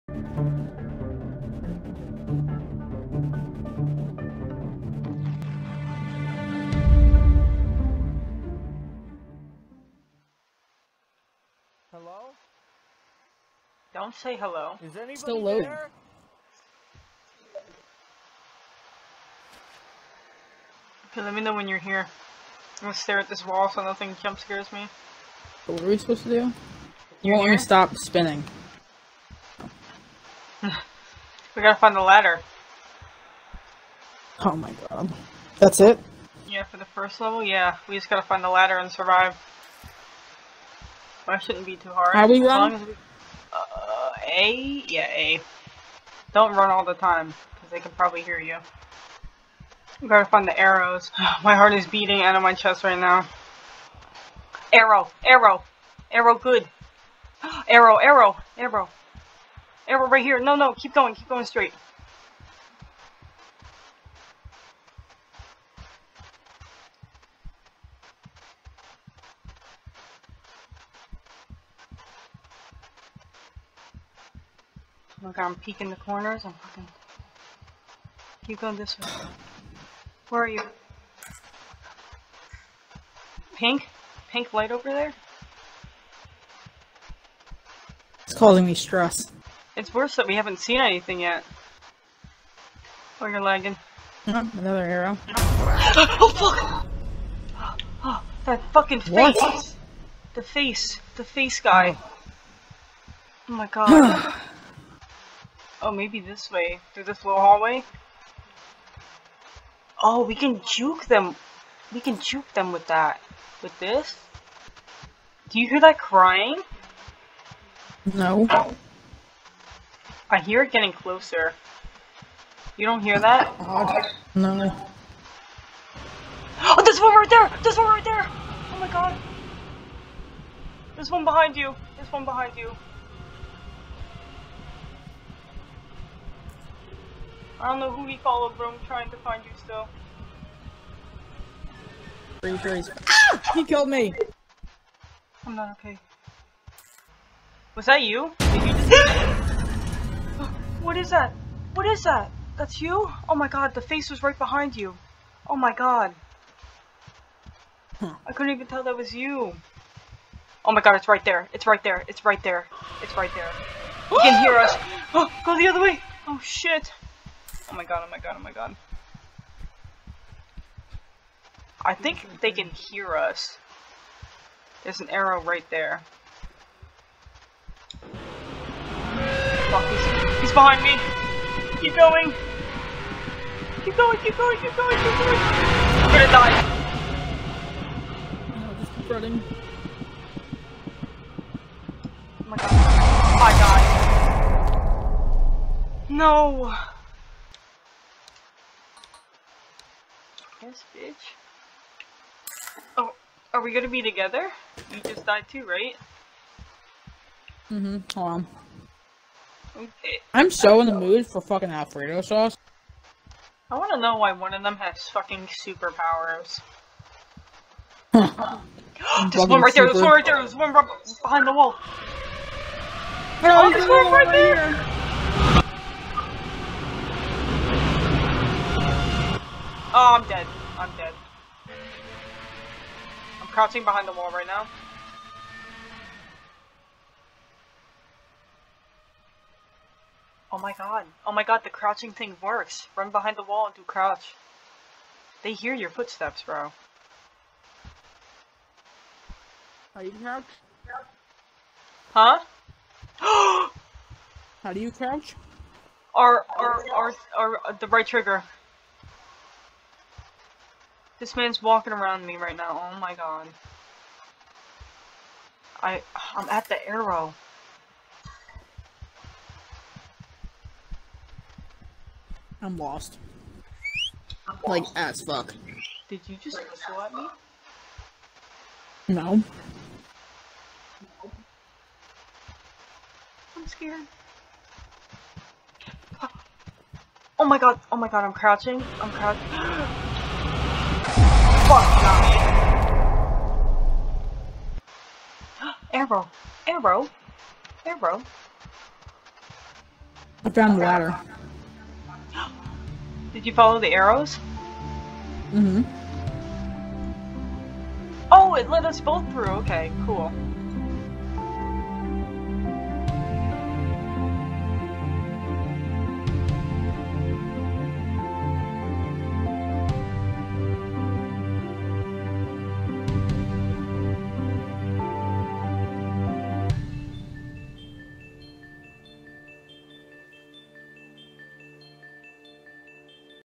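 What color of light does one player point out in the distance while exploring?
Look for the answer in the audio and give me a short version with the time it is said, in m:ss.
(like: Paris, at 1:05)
Pink, at 1:24.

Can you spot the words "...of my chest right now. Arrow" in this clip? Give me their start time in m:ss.
0:52.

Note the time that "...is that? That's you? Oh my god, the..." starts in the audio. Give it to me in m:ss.
2:31.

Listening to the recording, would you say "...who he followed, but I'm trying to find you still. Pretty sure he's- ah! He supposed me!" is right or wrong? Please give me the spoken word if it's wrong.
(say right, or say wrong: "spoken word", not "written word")
wrong: "killed", not "supposed".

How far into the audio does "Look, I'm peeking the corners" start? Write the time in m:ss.
1:15.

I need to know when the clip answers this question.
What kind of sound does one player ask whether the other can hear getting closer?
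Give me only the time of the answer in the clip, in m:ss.
1:55.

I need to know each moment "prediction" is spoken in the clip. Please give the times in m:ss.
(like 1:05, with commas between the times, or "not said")
not said.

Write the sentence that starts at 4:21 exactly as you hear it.
This man's walking around me right now.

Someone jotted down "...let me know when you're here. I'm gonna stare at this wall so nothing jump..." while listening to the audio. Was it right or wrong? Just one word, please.
right.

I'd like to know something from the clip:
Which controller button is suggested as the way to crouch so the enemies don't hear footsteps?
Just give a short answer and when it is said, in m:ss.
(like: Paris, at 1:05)
Right trigger, at 4:17.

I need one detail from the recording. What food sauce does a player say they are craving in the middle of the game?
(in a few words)
Alfredo sauce.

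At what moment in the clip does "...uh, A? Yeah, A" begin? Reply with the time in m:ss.
0:43.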